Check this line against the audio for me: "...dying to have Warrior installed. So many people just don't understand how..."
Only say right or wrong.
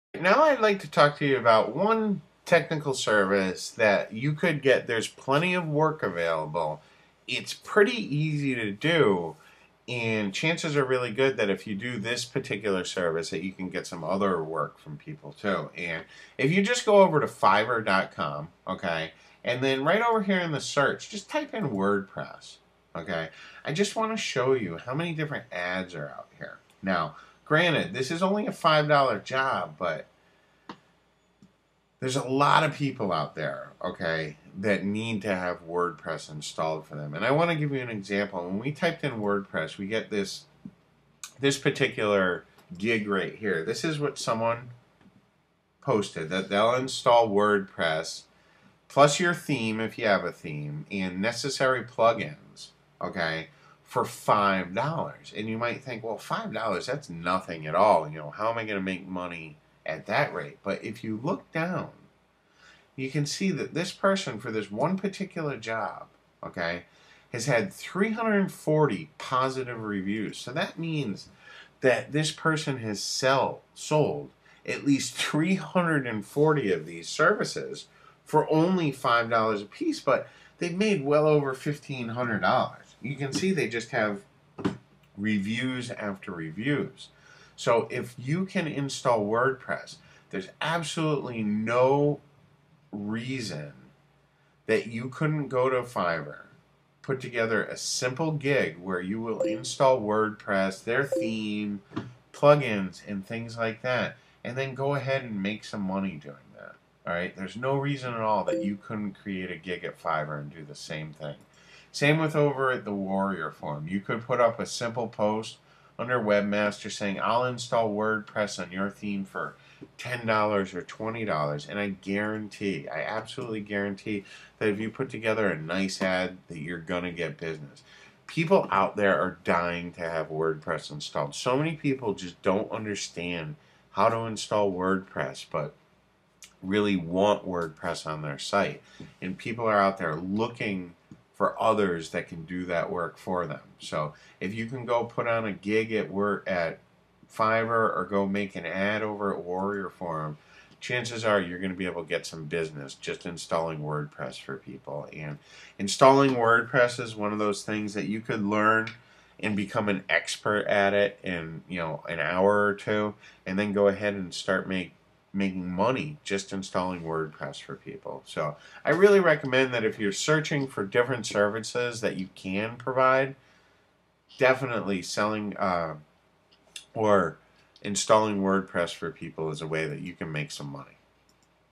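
wrong.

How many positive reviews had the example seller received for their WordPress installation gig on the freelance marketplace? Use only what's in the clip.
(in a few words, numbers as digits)
340.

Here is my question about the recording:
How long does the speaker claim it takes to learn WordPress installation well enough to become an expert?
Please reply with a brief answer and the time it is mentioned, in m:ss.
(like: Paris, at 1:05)
an hour or two, at 2:42.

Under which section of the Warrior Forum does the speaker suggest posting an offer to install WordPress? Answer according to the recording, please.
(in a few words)
Webmaster.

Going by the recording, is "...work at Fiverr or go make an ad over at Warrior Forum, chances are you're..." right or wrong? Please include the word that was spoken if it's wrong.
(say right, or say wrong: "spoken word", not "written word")
right.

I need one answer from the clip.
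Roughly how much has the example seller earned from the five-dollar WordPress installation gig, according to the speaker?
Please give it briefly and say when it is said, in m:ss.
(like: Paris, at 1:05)
over $1,500, at 1:21.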